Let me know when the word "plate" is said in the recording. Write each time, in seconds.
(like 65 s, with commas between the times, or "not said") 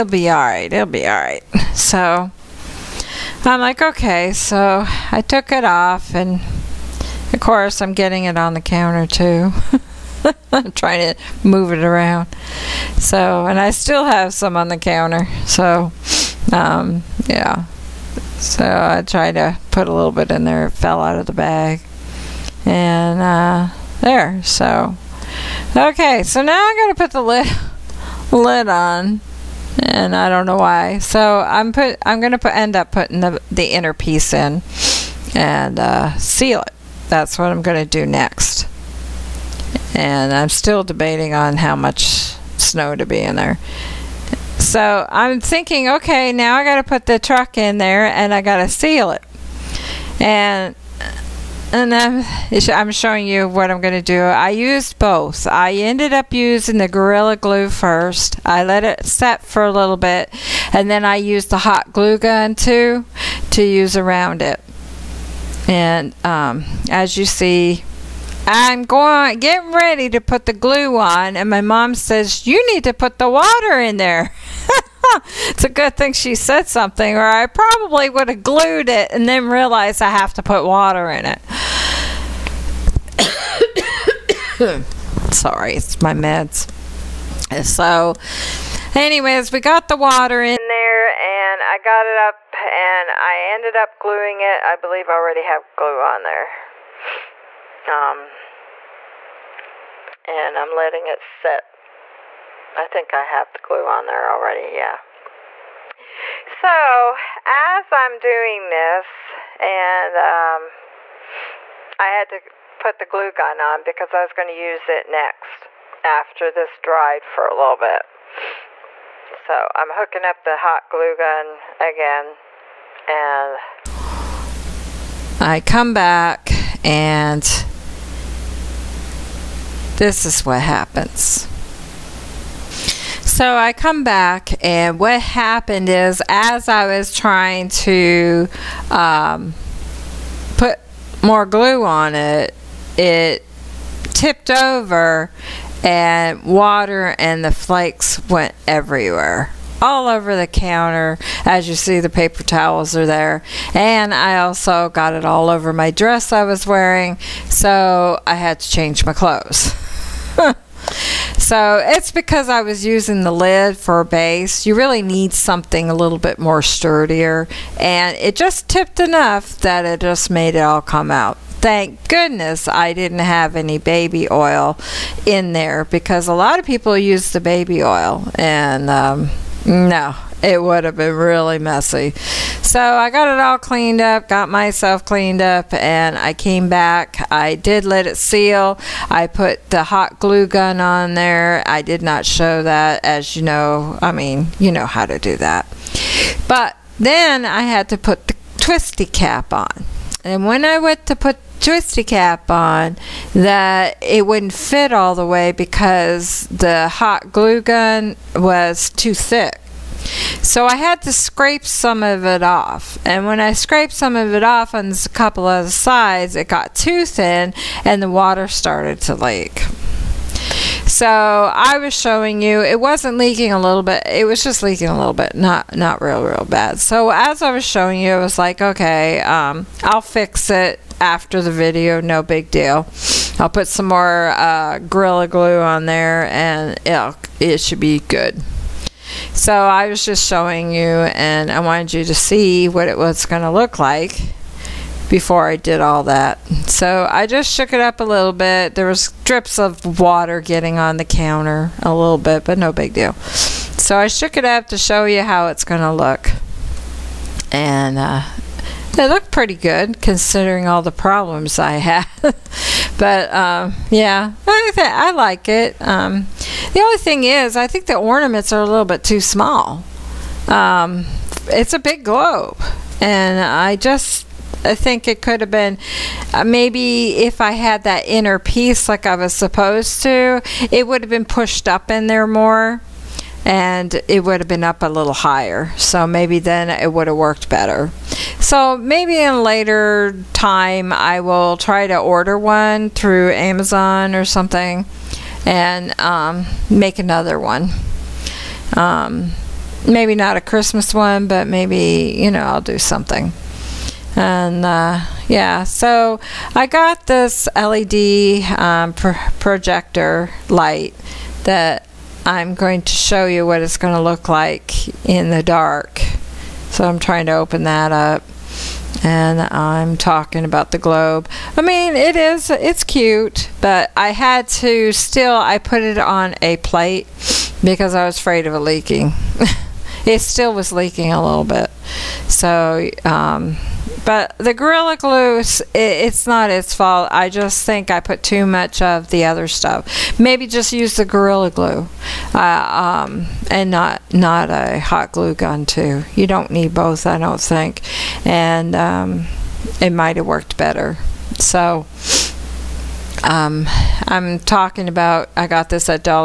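326 s.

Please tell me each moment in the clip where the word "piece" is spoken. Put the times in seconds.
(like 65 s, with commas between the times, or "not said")
33 s, 278 s.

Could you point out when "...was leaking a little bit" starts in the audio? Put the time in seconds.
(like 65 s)
330 s.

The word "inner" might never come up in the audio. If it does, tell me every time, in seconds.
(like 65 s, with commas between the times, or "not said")
33 s, 278 s.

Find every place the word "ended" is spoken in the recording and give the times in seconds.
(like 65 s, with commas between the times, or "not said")
55 s, 93 s.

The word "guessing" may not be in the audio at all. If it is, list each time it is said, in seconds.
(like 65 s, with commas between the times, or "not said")
not said.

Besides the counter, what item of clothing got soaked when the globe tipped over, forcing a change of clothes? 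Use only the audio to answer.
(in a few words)
dress.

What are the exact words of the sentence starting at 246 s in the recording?
So I just shook it up a little bit.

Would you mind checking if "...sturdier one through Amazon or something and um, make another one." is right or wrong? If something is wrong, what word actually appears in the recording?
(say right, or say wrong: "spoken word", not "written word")
wrong: "order", not "sturdier".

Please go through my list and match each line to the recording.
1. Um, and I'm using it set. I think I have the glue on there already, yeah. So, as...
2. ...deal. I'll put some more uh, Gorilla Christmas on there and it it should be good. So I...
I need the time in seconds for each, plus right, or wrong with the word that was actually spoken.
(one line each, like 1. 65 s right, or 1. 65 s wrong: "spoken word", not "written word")
1. 97 s wrong: "letting", not "using"
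2. 232 s wrong: "Glue", not "Christmas".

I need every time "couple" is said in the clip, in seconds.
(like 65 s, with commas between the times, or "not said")
215 s.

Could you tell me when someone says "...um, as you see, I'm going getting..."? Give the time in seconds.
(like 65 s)
66 s.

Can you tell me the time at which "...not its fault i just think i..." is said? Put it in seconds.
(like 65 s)
336 s.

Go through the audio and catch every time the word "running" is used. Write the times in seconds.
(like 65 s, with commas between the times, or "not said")
not said.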